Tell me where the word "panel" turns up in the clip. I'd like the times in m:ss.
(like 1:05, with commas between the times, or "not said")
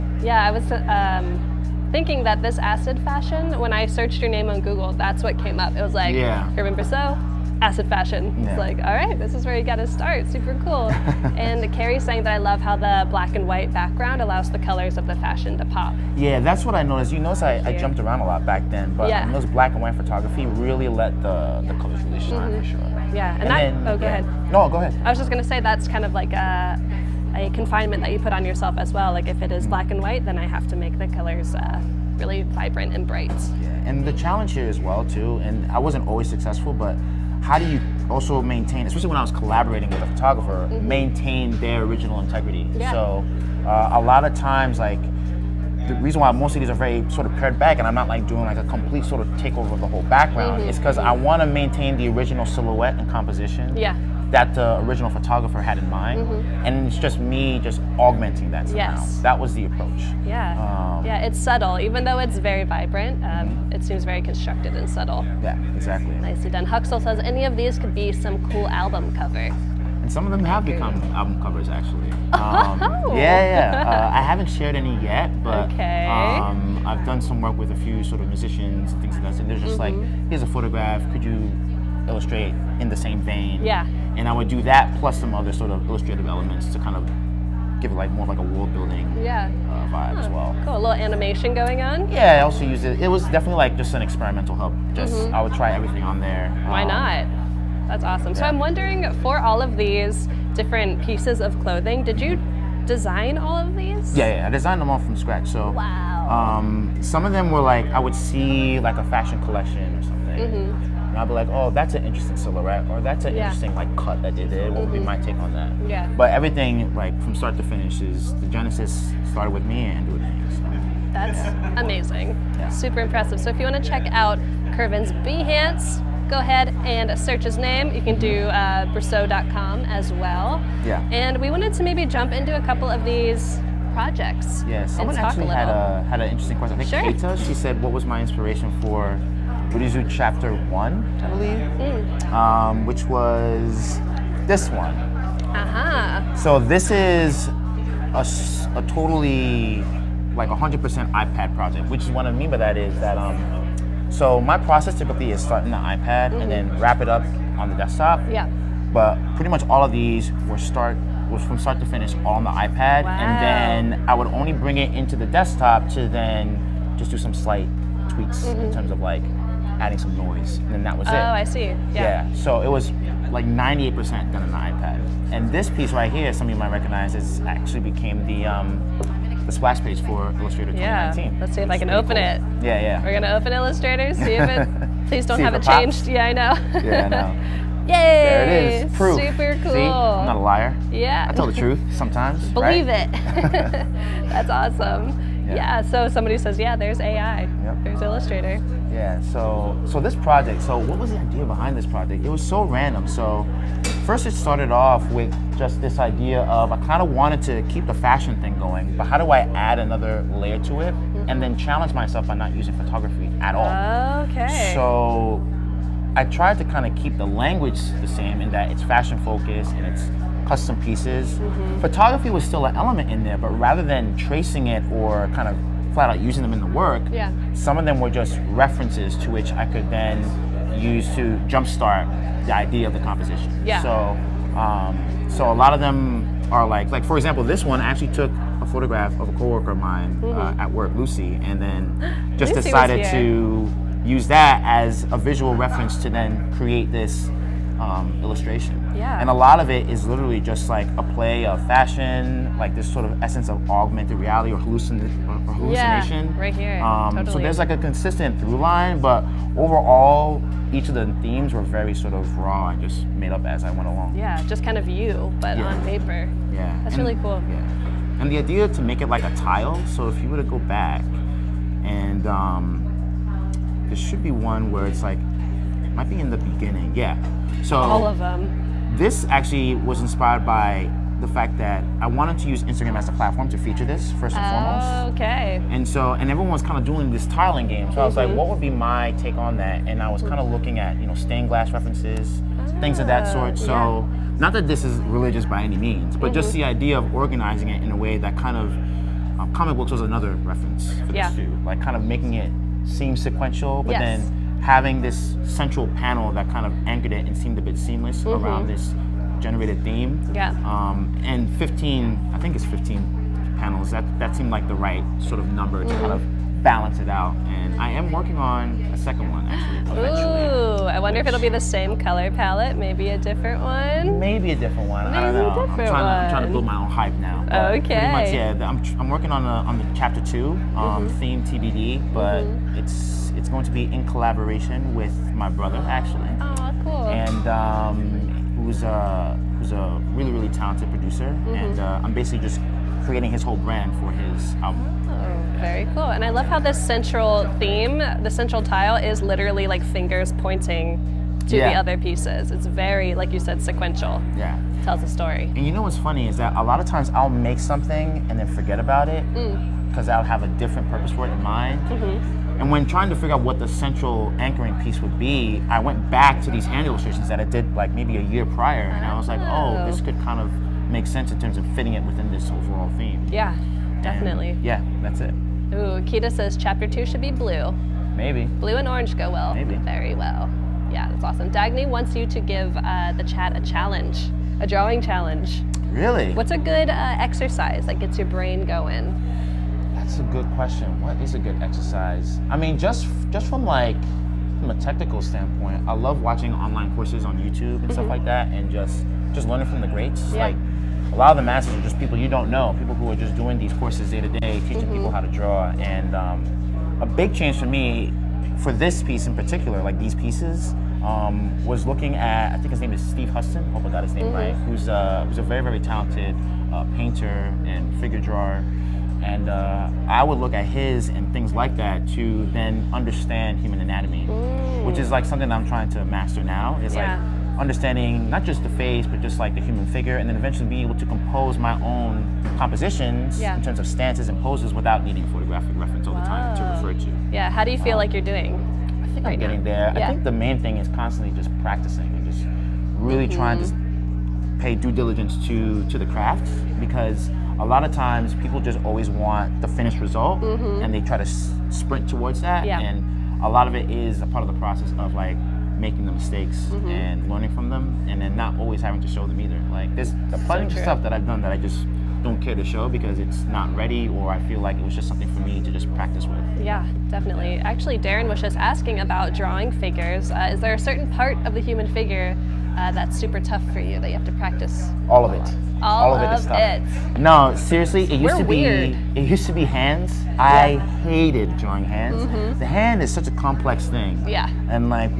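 5:05, 5:13.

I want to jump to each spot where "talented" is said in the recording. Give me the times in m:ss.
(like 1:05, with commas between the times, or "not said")
5:40, 6:55.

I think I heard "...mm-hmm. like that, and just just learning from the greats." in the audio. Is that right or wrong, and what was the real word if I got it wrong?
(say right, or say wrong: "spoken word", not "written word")
right.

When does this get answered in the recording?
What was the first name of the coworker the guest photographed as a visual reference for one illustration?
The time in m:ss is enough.
4:00.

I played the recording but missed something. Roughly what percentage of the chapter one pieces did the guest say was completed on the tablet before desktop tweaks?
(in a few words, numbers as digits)
98%.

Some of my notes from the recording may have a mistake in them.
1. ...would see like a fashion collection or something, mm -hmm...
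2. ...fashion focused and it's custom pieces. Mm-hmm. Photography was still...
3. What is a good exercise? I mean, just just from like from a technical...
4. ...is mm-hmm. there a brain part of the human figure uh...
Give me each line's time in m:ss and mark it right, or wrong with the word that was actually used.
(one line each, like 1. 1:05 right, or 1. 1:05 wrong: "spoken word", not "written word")
1. 1:47 right
2. 3:38 right
3. 6:30 right
4. 7:50 wrong: "certain", not "brain".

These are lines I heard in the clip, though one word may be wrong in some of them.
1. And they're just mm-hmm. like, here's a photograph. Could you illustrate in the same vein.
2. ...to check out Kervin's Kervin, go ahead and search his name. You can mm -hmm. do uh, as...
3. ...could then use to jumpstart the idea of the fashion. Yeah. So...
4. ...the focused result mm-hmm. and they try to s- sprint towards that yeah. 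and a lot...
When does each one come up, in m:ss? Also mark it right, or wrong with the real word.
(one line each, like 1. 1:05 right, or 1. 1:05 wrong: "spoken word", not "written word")
1. 1:19 right
2. 2:03 wrong: "Behance", not "Kervin"
3. 3:49 wrong: "composition", not "fashion"
4. 7:29 wrong: "finished", not "focused".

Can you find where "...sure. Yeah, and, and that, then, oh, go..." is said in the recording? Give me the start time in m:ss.
0:22.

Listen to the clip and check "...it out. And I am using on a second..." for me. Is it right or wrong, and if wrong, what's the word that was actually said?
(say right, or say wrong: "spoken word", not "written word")
wrong: "working", not "using".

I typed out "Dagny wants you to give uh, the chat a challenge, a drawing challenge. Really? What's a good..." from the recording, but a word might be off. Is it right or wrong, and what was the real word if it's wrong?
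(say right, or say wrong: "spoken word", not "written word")
right.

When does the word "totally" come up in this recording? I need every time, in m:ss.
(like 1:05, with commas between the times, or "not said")
2:28, 4:17.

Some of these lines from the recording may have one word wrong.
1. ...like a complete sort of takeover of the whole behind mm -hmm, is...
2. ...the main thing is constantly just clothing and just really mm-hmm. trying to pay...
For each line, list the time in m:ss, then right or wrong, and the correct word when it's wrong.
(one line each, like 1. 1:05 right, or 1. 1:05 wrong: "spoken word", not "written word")
1. 0:48 wrong: "background", not "behind"
2. 7:20 wrong: "practicing", not "clothing".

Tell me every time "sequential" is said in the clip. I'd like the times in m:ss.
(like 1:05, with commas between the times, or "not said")
5:03, 5:53.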